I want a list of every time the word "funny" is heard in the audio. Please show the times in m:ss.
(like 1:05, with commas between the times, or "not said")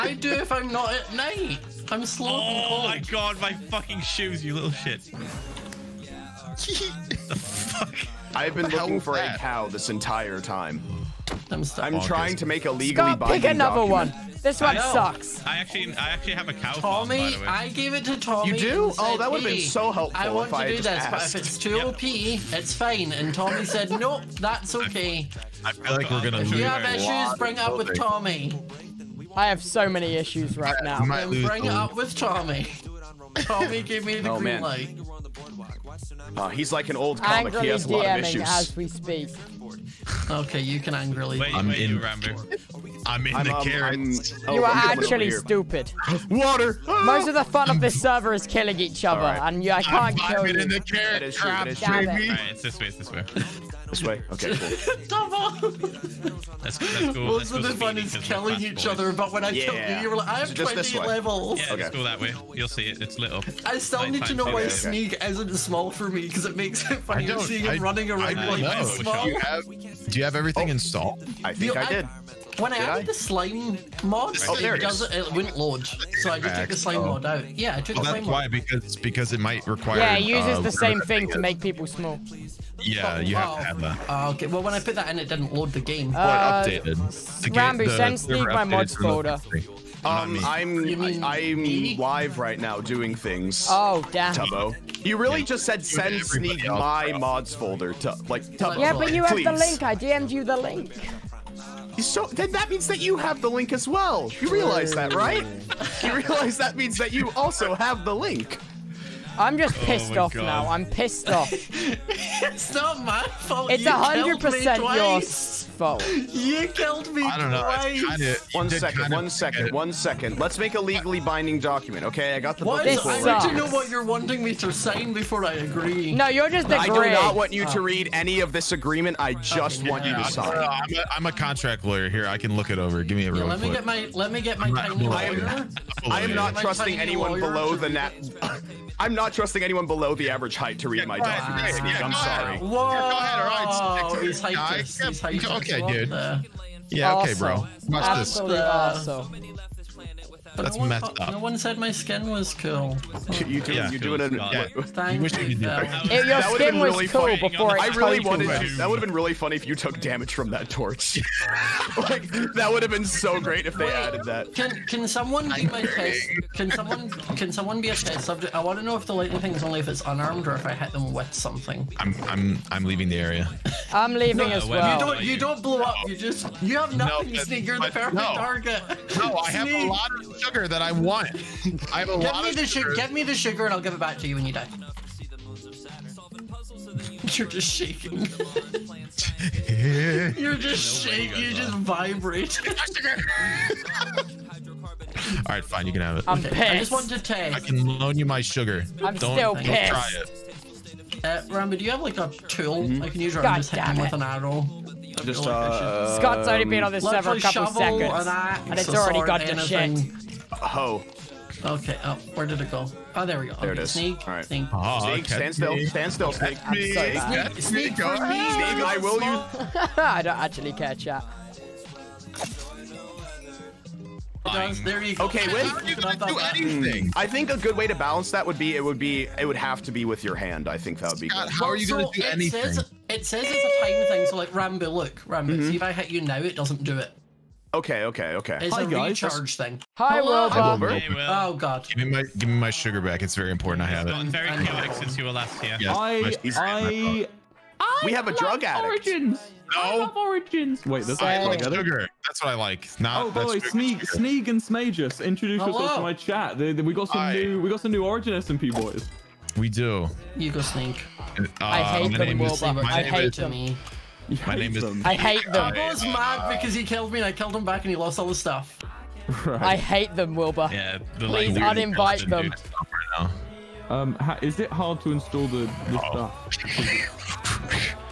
1:06, 2:39.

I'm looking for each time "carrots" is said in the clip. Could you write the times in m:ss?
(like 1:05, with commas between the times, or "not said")
0:43, 0:50.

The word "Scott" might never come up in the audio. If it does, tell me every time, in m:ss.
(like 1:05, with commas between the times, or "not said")
0:13, 3:26, 3:51.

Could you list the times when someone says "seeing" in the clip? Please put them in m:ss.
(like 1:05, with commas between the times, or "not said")
1:07.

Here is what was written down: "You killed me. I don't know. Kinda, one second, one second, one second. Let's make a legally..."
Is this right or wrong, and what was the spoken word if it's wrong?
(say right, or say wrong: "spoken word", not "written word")
right.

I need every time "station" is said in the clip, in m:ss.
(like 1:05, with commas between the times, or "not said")
not said.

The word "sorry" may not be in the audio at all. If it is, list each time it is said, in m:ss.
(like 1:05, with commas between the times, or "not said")
2:22, 3:36.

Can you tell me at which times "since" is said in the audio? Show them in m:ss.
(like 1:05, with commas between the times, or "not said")
4:04.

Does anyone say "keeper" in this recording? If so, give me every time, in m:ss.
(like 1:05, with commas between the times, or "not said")
not said.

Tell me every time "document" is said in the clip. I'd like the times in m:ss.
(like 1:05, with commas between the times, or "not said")
0:13, 2:01, 2:21.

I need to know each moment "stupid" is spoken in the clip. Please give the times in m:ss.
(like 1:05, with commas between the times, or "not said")
0:45.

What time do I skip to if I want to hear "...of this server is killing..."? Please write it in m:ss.
0:47.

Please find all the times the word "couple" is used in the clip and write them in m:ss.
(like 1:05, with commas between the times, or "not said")
3:27.